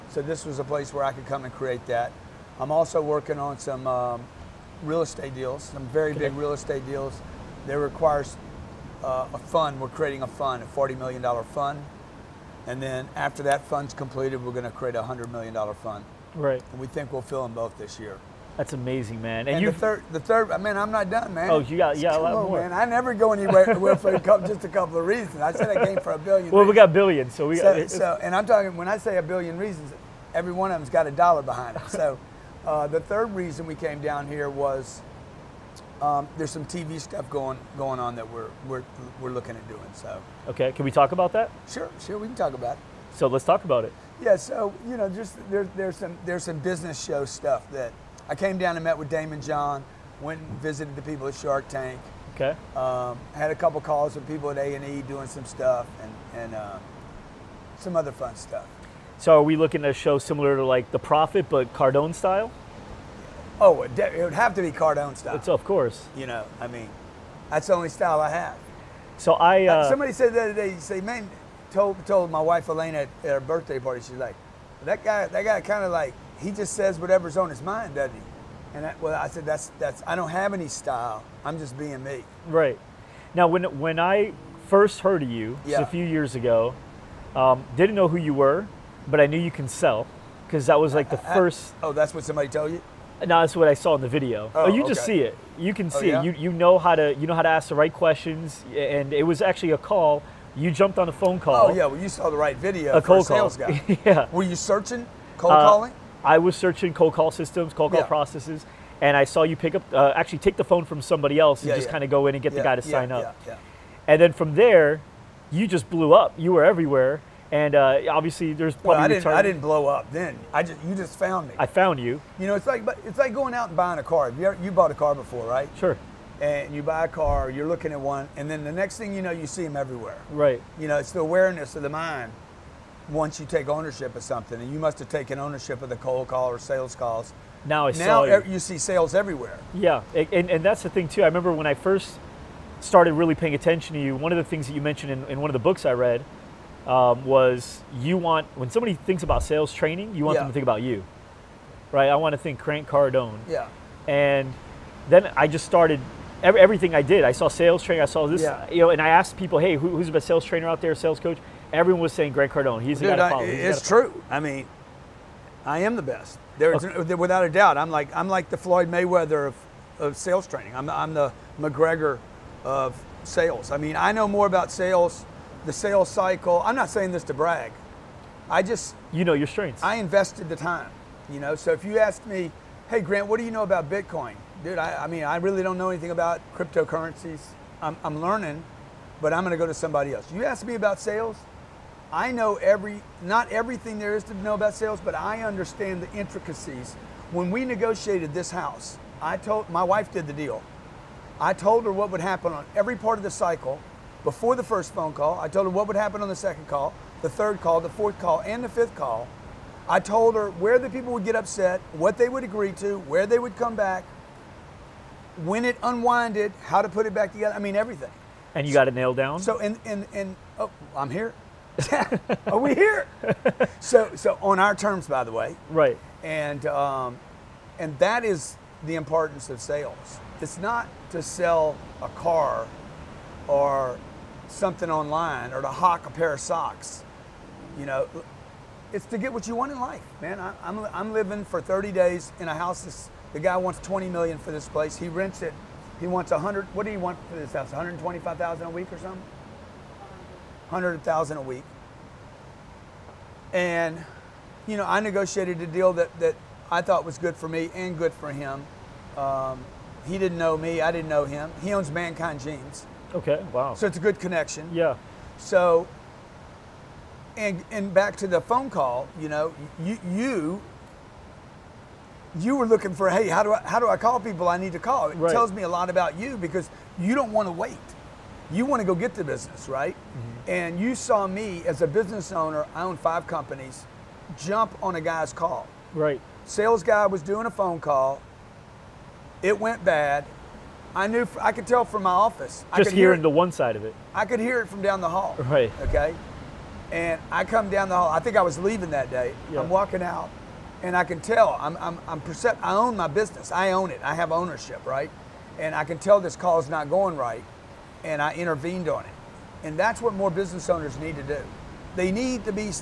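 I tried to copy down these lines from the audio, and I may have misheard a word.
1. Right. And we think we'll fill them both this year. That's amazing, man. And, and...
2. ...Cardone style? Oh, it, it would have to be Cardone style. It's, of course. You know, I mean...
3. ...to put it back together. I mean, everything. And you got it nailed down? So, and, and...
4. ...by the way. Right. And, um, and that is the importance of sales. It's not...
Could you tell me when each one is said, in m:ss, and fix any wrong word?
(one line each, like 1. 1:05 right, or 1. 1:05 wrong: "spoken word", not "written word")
1. 0:16 right
2. 1:01 right
3. 3:36 right
4. 3:45 right.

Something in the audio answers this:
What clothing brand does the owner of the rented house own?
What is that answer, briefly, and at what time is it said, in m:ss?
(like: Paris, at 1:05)
Mankind Jeans, at 4:21.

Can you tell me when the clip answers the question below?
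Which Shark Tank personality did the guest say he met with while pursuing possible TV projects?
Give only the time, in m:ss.
0:49.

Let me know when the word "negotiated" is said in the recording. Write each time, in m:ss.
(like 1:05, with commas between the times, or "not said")
3:17, 4:14.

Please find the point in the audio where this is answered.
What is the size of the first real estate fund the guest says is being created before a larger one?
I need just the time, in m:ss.
0:10.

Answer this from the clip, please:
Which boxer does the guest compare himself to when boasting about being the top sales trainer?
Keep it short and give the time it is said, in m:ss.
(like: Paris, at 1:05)
Floyd Mayweather, at 2:48.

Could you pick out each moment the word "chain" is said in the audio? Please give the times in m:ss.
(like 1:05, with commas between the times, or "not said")
not said.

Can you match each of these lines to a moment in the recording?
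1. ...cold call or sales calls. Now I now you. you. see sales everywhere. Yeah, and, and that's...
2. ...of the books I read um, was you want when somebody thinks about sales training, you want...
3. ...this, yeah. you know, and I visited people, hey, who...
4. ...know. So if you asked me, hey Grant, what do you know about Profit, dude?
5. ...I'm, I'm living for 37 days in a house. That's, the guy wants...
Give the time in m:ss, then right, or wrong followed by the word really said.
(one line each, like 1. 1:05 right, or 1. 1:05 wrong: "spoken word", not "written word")
1. 2:15 right
2. 2:25 right
3. 2:38 wrong: "asked", not "visited"
4. 3:01 wrong: "Bitcoin", not "Profit"
5. 4:00 wrong: "30", not "37".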